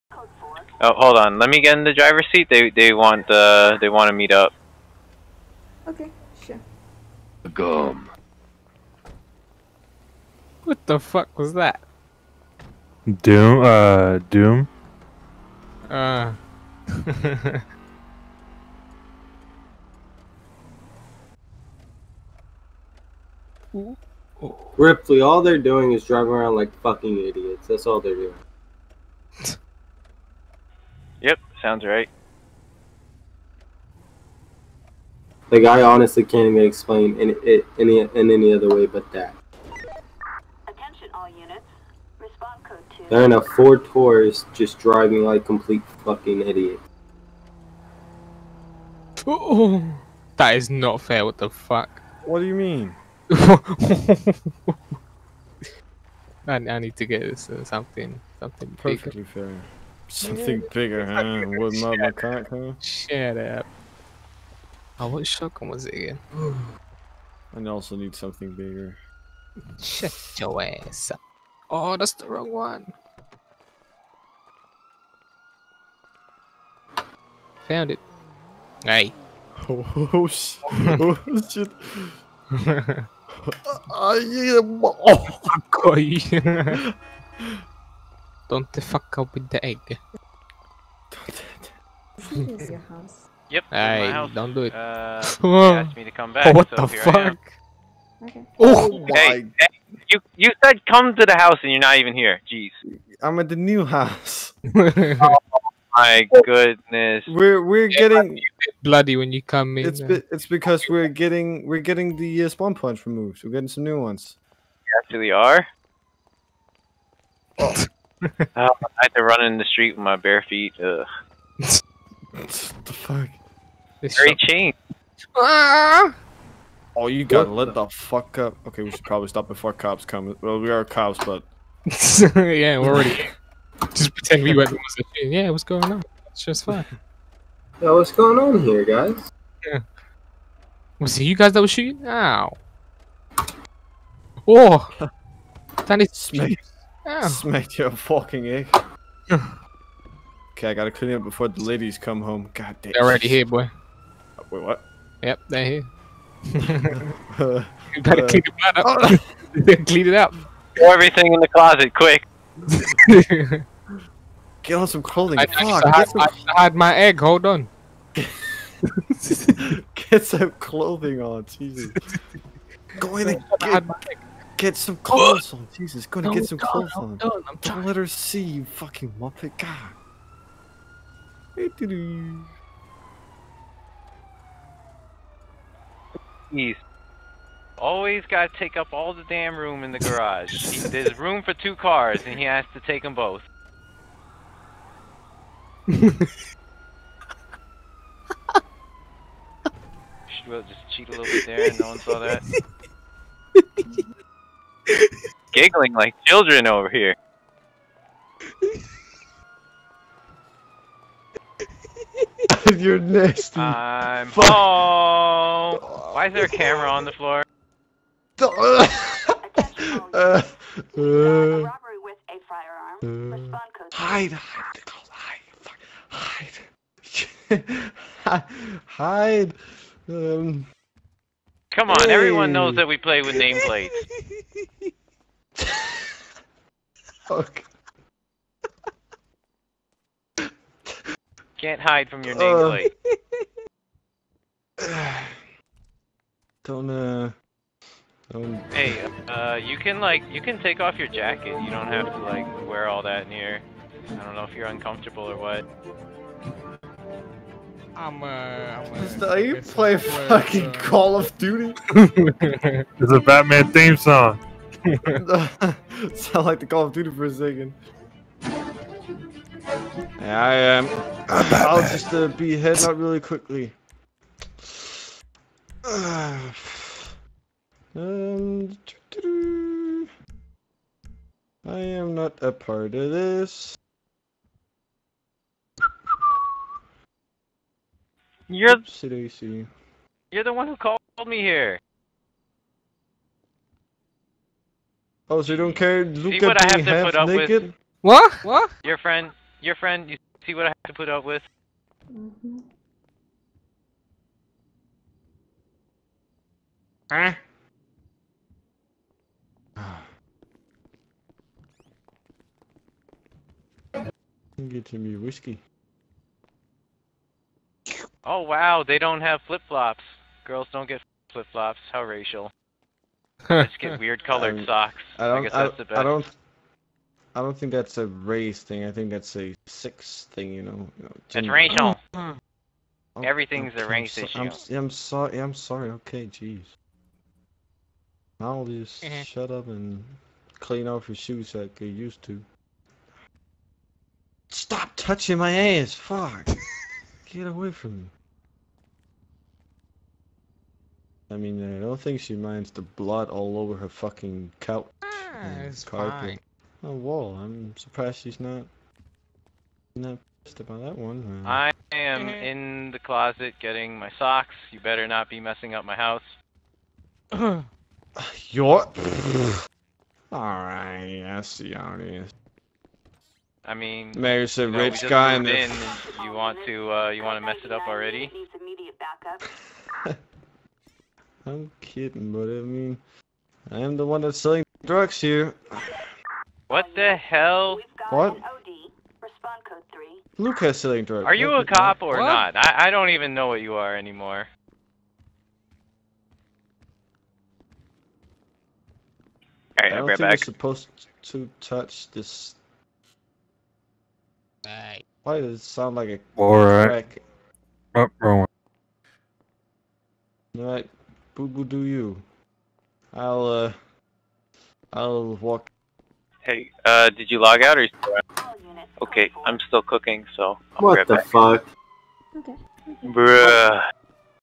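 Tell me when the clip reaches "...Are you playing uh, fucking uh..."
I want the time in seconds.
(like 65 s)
259 s.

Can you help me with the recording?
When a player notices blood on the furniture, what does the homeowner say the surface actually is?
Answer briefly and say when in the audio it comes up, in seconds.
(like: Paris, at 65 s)
Carpet, at 355 s.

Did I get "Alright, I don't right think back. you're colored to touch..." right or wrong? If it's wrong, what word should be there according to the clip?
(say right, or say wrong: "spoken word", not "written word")
wrong: "supposed", not "colored".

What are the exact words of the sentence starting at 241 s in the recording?
Can't hide from your uh, nameplate.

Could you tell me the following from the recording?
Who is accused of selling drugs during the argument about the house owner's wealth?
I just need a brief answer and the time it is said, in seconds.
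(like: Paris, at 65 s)
Lucas, at 390 s.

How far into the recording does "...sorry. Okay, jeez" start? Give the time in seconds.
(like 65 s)
335 s.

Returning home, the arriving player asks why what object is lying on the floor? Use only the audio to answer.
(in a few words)
Camera.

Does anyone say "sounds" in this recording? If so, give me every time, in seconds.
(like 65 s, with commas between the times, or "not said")
31 s, 266 s, 405 s.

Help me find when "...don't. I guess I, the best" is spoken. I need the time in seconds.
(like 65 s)
325 s.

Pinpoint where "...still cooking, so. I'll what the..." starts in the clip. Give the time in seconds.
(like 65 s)
419 s.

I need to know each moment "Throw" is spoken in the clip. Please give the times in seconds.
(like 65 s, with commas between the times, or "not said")
160 s.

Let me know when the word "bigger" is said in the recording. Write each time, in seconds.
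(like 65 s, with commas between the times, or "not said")
60 s, 68 s.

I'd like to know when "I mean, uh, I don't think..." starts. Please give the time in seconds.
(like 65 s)
351 s.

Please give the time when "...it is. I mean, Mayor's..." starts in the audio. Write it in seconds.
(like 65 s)
371 s.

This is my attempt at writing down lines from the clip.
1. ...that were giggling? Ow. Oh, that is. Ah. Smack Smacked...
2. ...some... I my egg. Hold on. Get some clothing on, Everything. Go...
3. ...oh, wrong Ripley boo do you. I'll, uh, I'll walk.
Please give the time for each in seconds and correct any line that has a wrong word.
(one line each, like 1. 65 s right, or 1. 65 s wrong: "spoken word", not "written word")
1. 141 s wrong: "shooting", not "giggling"
2. 166 s wrong: "Jesus", not "Everything"
3. 408 s wrong: "Boo", not "Ripley".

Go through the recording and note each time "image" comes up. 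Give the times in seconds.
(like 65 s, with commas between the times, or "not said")
not said.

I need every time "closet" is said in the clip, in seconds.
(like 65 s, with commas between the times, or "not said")
161 s, 362 s.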